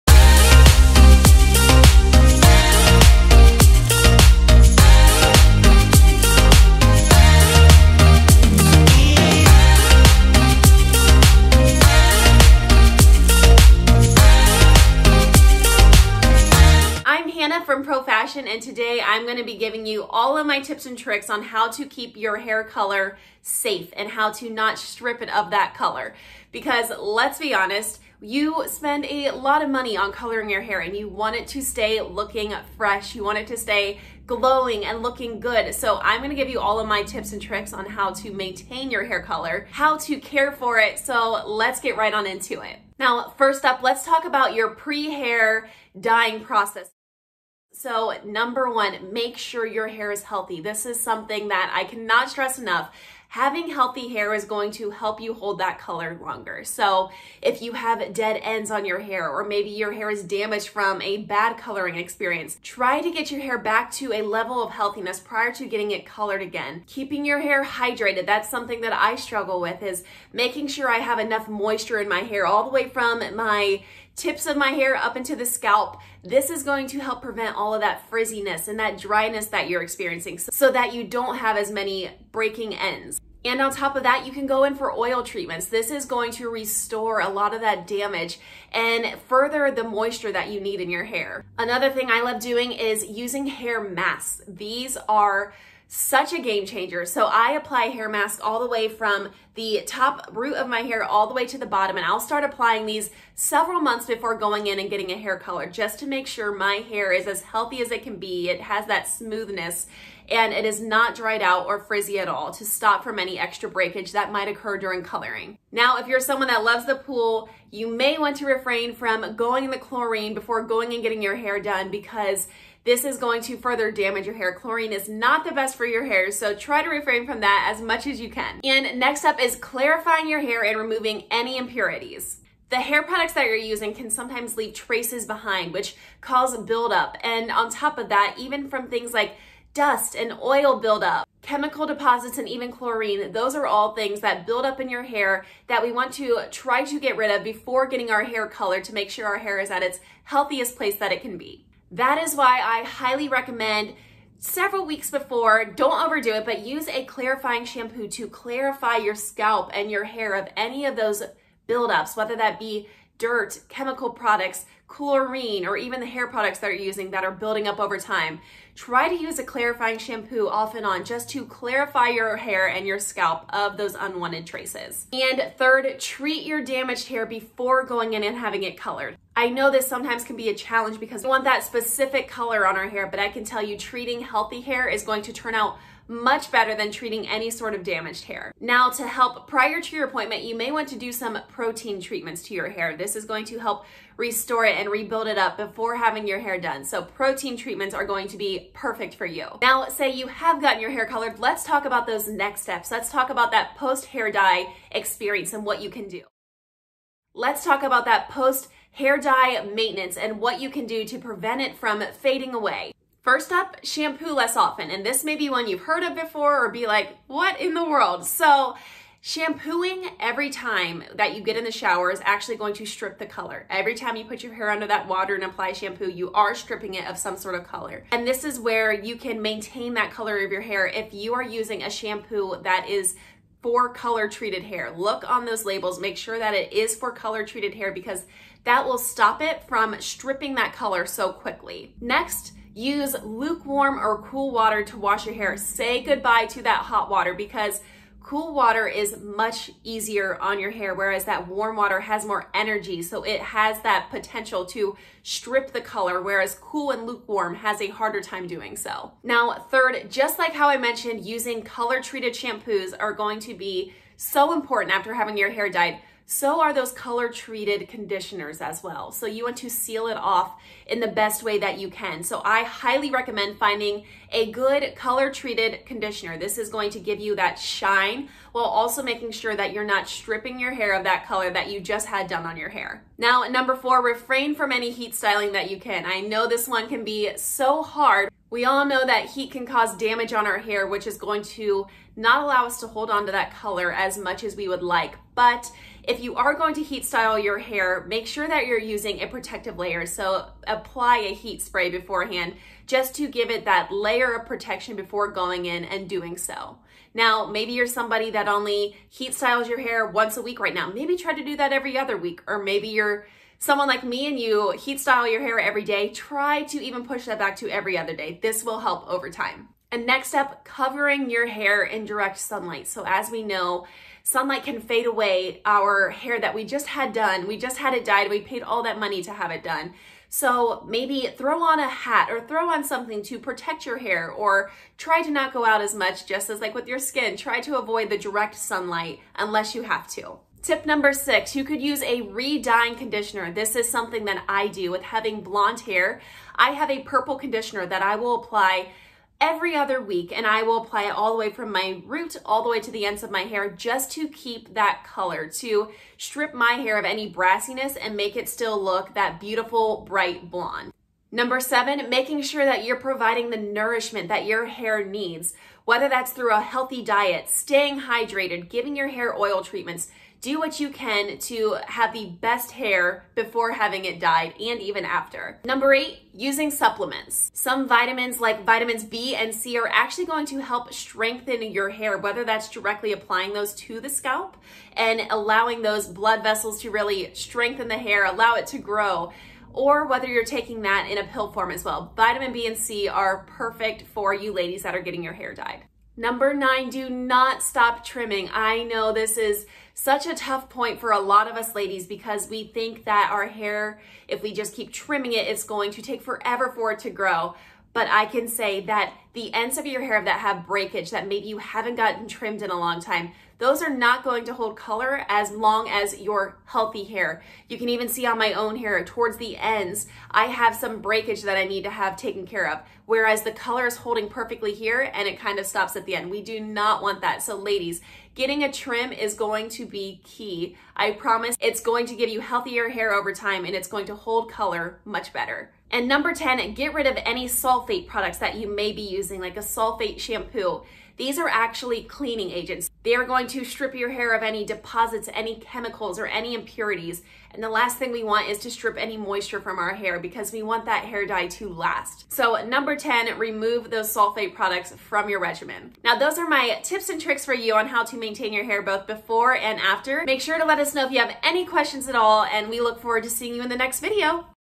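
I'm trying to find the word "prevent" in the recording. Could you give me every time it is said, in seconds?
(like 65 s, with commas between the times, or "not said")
77 s, 211 s.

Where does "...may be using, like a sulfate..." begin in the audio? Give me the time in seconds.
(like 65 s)
438 s.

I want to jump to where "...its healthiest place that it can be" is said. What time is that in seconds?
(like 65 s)
149 s.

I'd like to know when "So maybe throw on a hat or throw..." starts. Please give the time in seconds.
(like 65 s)
330 s.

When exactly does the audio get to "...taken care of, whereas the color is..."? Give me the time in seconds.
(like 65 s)
422 s.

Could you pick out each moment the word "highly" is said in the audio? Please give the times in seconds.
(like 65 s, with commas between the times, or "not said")
152 s, 272 s.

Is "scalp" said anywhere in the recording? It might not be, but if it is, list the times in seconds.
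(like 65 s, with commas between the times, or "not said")
75 s, 159 s, 172 s, 384 s.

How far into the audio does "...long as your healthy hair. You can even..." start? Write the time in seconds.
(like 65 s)
415 s.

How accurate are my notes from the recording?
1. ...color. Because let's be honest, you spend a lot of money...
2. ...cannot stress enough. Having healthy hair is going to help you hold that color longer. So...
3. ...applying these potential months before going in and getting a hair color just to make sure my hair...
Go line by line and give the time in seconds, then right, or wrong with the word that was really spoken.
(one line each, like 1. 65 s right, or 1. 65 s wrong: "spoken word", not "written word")
1. 25 s right
2. 51 s right
3. 102 s wrong: "several", not "potential".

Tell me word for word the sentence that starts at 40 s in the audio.
So let's get right on into it.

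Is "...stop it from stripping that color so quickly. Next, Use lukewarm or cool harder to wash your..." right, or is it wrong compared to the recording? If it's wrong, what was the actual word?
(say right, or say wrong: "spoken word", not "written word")
wrong: "water", not "harder".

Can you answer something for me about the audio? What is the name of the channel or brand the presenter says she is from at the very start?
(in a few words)
Pro Fashion.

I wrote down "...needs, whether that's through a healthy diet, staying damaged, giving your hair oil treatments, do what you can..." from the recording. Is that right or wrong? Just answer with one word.
wrong.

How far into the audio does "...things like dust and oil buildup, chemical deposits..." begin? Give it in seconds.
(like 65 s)
138 s.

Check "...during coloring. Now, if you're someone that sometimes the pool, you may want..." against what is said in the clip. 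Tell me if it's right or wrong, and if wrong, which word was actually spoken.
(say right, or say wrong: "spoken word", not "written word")
wrong: "loves", not "sometimes".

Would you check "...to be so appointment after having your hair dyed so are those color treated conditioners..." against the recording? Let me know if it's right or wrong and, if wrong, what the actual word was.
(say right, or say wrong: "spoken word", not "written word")
wrong: "important", not "appointment".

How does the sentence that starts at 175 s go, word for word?
And third, treat your damaged hair before going in and having it colored.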